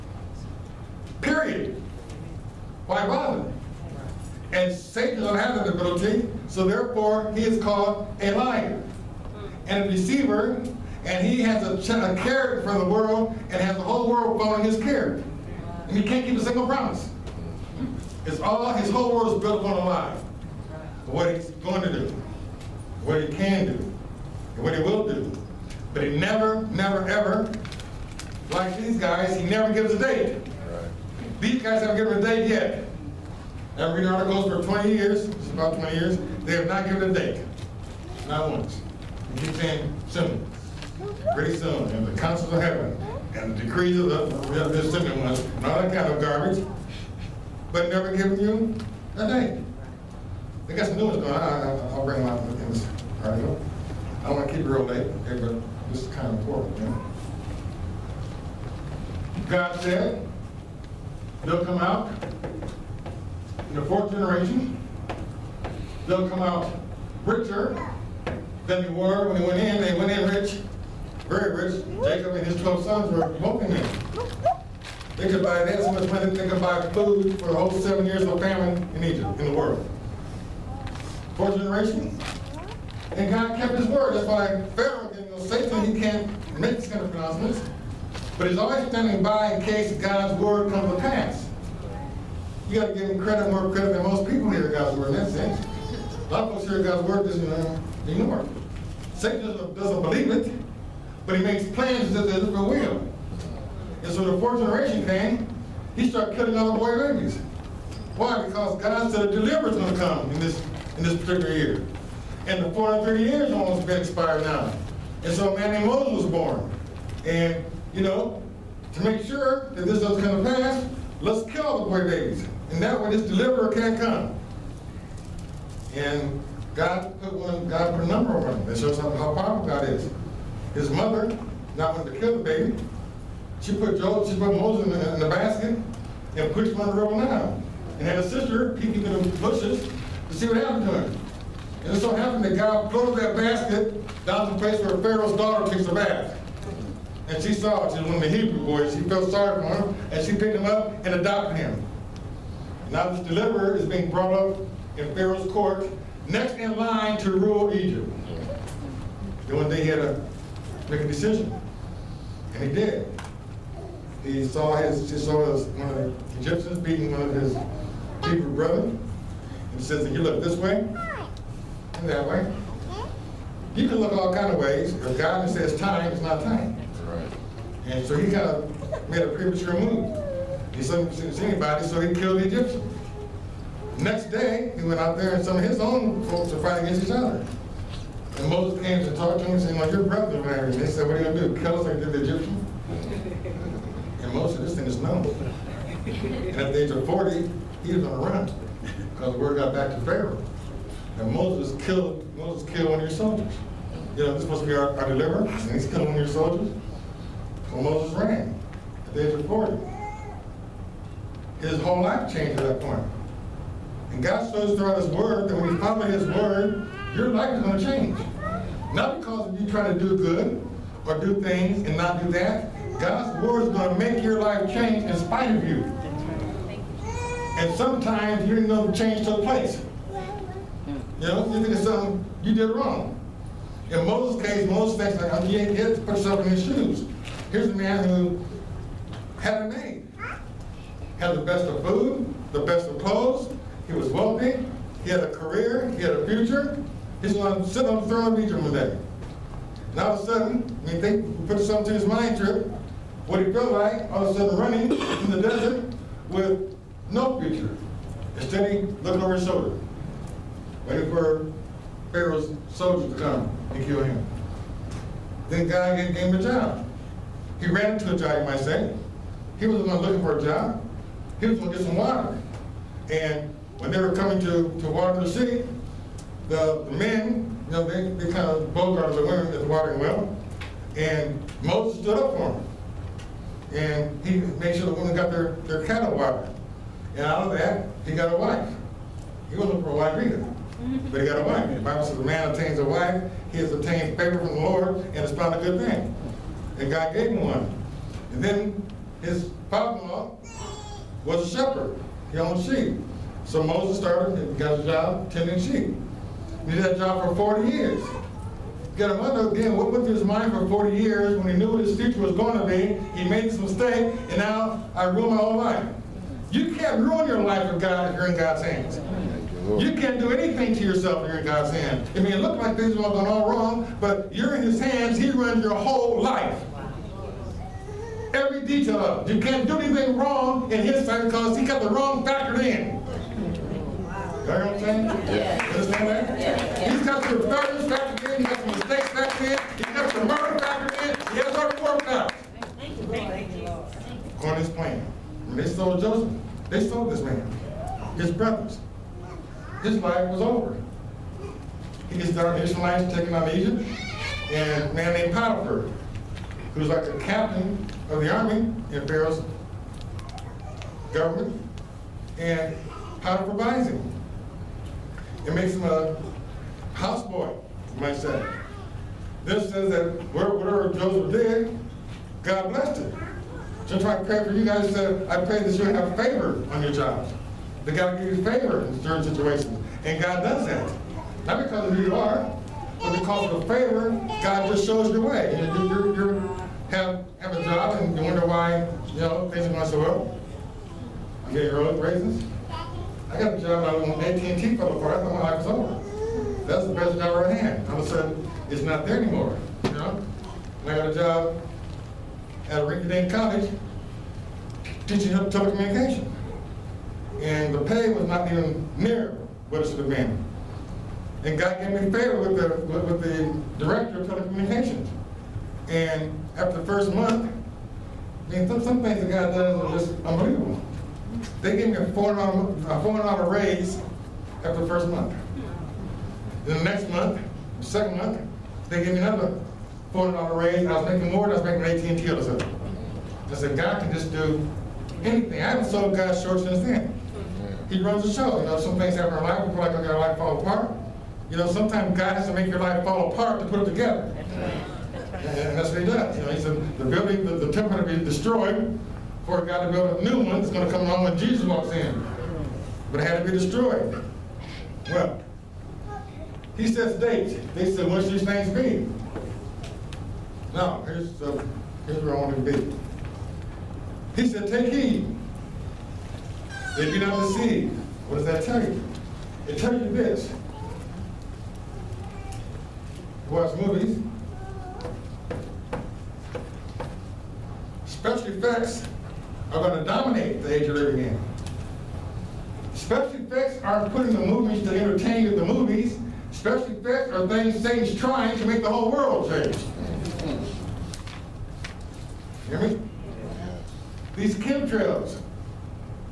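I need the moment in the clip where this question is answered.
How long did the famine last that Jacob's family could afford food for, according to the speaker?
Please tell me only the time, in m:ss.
1:17.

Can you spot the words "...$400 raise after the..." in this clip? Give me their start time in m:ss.
7:02.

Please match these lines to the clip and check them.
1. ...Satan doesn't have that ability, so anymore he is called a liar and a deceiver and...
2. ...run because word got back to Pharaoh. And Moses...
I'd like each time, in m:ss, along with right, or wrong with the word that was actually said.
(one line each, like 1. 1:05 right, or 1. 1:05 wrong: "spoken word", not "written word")
1. 0:04 wrong: "therefore", not "anymore"
2. 3:18 right.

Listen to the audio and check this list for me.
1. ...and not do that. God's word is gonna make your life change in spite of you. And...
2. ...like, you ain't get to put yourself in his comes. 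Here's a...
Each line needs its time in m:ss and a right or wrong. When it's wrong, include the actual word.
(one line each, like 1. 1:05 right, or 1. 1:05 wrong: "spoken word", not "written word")
1. 3:41 right
2. 3:55 wrong: "shoes", not "comes".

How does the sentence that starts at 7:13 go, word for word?
I said, God can just do anything.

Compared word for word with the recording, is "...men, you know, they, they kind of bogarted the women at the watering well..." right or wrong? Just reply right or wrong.
right.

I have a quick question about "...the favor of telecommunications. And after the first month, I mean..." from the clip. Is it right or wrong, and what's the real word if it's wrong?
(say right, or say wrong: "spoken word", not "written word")
wrong: "director", not "favor".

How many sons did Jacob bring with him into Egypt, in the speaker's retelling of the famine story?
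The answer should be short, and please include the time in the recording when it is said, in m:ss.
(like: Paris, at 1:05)
12, at 1:12.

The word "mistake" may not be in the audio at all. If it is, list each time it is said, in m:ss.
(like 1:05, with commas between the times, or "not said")
5:13, 5:38.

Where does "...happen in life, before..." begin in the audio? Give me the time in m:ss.
7:19.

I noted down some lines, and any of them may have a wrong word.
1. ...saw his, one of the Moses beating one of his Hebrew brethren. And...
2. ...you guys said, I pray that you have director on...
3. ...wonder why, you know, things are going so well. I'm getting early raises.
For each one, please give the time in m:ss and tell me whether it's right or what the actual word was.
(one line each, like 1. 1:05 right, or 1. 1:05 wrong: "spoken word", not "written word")
1. 2:45 wrong: "Egyptians", not "Moses"
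2. 6:14 wrong: "favor", not "director"
3. 6:28 right.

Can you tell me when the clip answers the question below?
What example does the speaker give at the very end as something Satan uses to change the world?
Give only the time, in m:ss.
8:14.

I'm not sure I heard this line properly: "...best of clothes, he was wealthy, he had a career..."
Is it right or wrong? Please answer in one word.
right.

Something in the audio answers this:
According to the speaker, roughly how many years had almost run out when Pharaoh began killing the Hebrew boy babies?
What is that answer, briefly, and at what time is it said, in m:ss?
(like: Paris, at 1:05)
430 years, at 1:52.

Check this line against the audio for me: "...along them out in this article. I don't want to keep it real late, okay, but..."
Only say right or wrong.
wrong.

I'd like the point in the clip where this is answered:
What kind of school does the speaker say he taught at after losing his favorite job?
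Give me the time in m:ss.
6:42.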